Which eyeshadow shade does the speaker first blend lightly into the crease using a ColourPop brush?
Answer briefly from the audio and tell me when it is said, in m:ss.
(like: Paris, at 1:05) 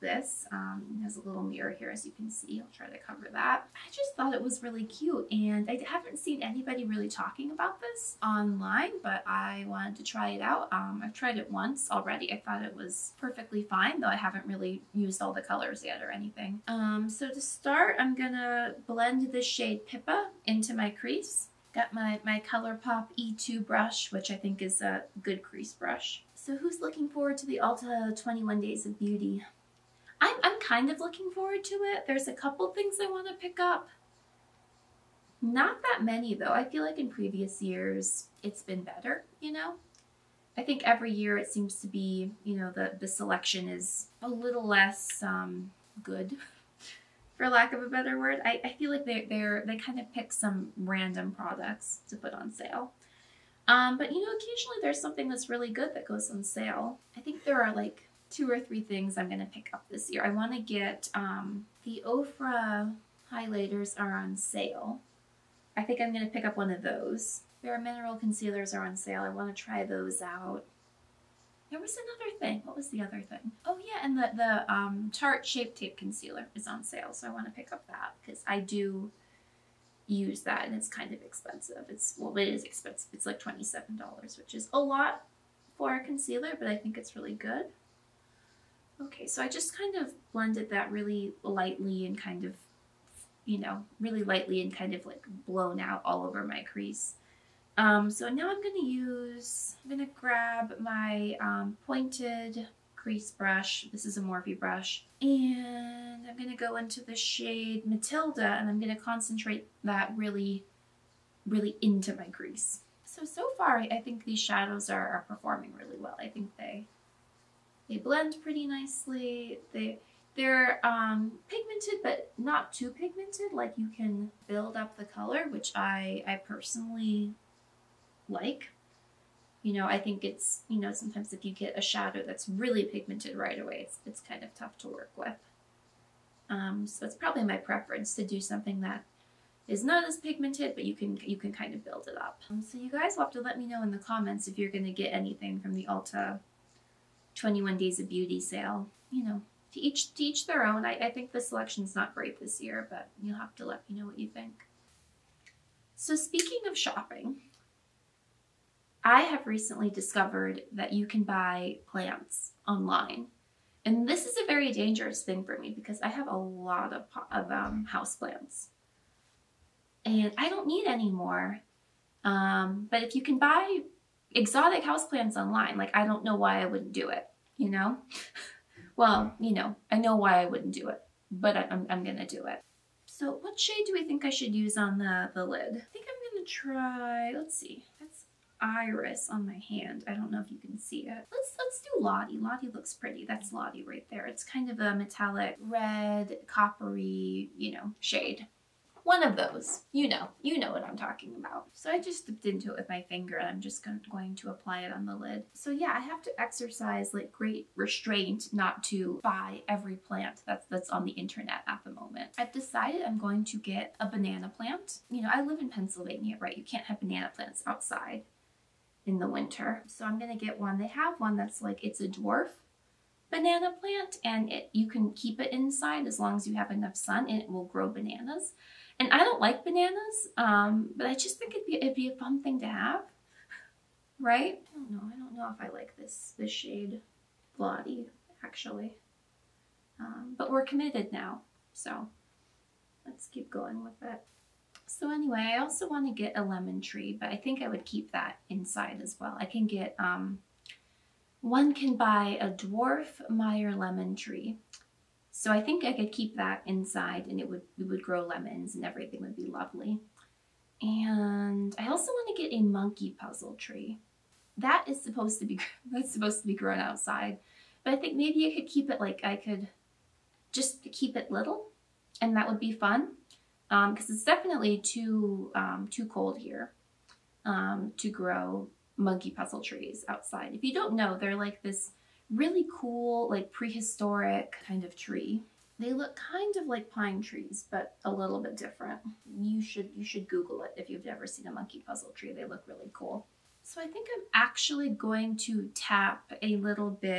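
Pippa, at 0:19.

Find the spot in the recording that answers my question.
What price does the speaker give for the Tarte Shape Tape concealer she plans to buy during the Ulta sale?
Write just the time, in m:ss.
1:23.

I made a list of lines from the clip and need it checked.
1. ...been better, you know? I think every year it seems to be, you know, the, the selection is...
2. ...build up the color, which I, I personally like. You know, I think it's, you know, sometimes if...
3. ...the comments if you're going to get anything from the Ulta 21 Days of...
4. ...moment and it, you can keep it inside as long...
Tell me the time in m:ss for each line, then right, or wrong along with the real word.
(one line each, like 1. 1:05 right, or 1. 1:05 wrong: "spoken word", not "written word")
1. 0:38 right
2. 2:04 right
3. 2:23 right
4. 3:43 wrong: "plant", not "moment".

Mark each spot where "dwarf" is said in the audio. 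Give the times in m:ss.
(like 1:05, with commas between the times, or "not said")
3:42, 4:12.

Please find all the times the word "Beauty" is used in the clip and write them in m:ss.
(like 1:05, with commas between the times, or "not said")
0:28, 2:28.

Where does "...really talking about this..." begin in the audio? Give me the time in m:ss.
0:06.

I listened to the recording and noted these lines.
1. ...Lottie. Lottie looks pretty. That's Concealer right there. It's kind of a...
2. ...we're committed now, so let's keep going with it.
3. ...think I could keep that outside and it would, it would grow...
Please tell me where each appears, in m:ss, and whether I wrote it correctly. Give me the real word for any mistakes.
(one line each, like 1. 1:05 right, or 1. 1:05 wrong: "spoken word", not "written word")
1. 3:11 wrong: "Lottie", not "Concealer"
2. 4:00 right
3. 4:15 wrong: "inside", not "outside".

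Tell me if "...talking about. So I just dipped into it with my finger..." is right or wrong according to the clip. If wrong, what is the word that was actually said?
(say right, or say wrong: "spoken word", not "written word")
right.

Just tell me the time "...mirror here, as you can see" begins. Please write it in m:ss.
0:01.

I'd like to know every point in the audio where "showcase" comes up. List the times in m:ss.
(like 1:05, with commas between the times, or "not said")
not said.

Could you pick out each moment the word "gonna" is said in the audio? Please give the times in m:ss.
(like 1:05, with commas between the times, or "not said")
0:18, 0:59, 1:06, 3:02, 3:06, 3:40.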